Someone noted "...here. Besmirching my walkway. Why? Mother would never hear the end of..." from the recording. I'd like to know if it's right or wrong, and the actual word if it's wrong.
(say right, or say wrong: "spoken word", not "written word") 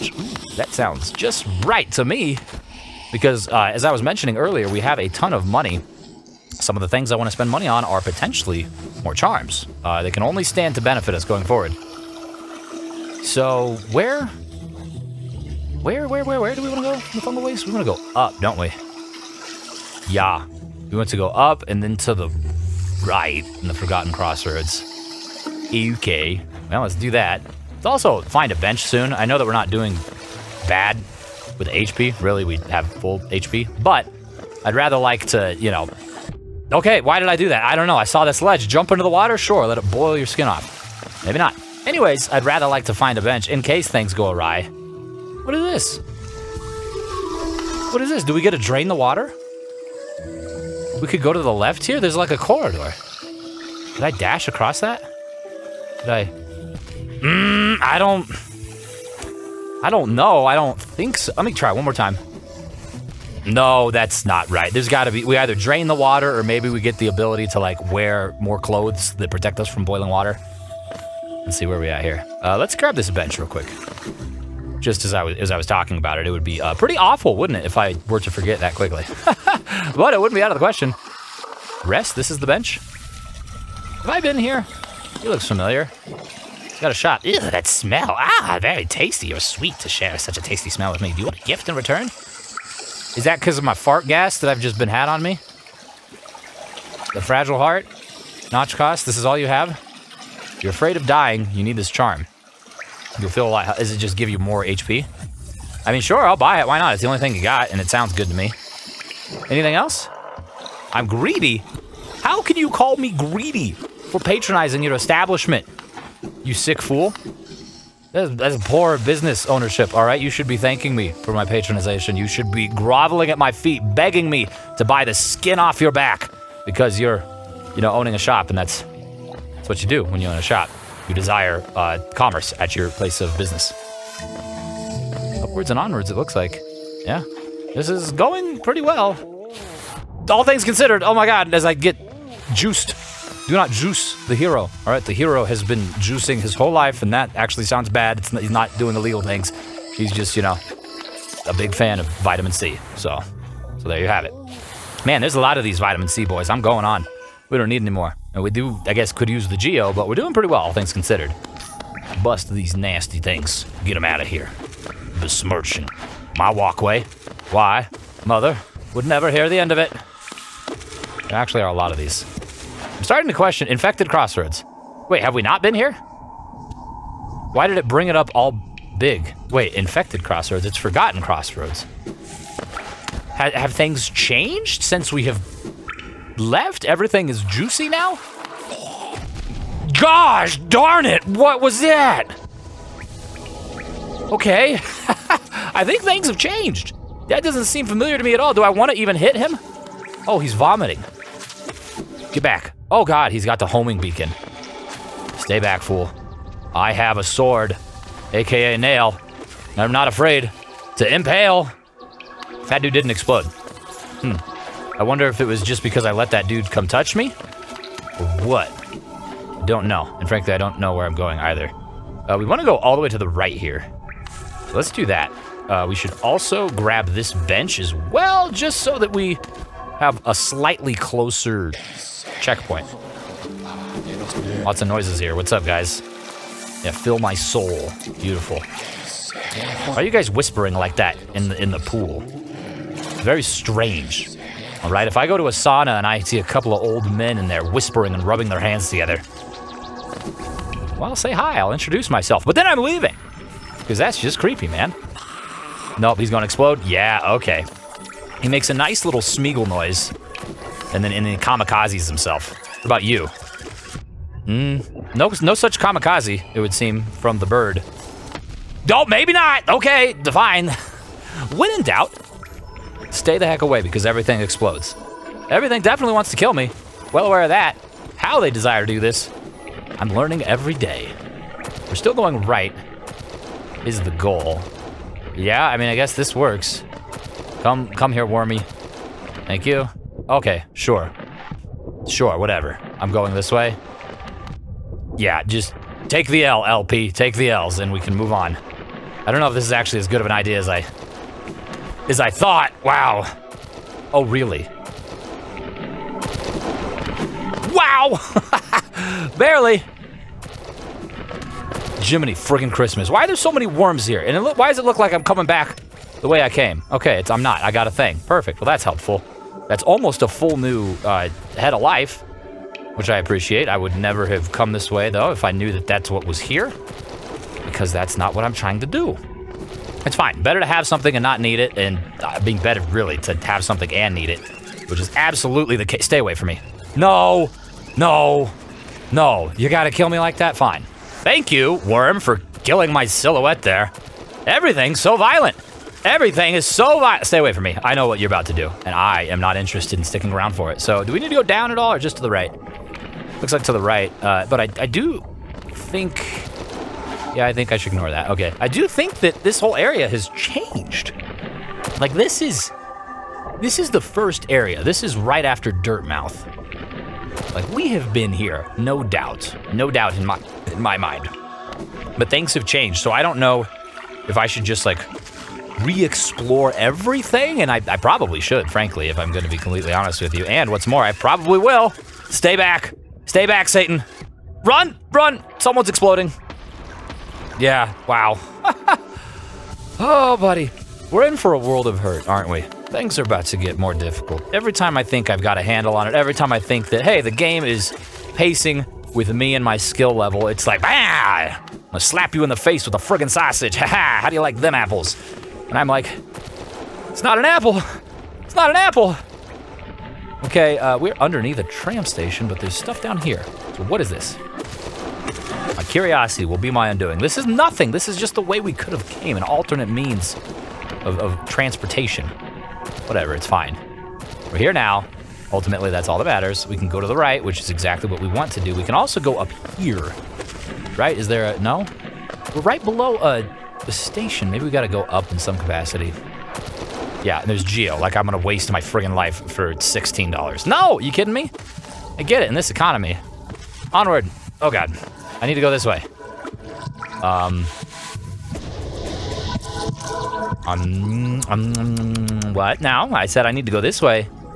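right.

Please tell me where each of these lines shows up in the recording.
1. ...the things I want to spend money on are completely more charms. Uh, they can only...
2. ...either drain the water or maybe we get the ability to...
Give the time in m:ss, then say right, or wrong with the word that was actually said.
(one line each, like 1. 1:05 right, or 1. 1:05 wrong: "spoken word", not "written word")
1. 0:06 wrong: "potentially", not "completely"
2. 1:05 right.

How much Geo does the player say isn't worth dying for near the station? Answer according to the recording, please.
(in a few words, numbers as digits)
$16.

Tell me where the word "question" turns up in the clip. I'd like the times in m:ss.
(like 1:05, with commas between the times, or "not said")
1:20, 2:53.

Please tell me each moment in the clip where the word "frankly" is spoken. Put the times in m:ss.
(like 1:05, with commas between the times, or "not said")
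3:40, 6:18.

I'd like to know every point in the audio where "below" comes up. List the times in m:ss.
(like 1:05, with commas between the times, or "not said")
7:12.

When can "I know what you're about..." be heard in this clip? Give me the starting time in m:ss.
5:47.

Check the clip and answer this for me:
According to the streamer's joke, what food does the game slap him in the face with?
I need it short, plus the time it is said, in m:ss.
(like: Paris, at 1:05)
sausage, at 6:43.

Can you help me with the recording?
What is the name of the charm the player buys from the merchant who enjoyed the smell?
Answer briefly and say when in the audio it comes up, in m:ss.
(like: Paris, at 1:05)
Fragile Heart, at 1:37.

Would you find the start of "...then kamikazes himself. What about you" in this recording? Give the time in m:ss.
4:21.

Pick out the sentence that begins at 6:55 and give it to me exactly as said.
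My curiosity will be my undoing.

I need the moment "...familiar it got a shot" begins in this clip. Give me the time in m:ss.
1:25.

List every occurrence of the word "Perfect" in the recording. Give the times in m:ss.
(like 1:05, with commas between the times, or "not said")
5:18.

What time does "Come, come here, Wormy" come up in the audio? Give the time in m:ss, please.
4:47.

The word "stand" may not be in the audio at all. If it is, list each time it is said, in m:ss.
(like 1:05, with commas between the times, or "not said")
0:10.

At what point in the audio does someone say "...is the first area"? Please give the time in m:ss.
6:03.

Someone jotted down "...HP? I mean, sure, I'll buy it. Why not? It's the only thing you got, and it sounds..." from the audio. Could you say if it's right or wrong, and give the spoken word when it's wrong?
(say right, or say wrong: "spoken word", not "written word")
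right.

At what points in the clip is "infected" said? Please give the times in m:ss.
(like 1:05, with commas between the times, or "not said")
2:53, 2:59.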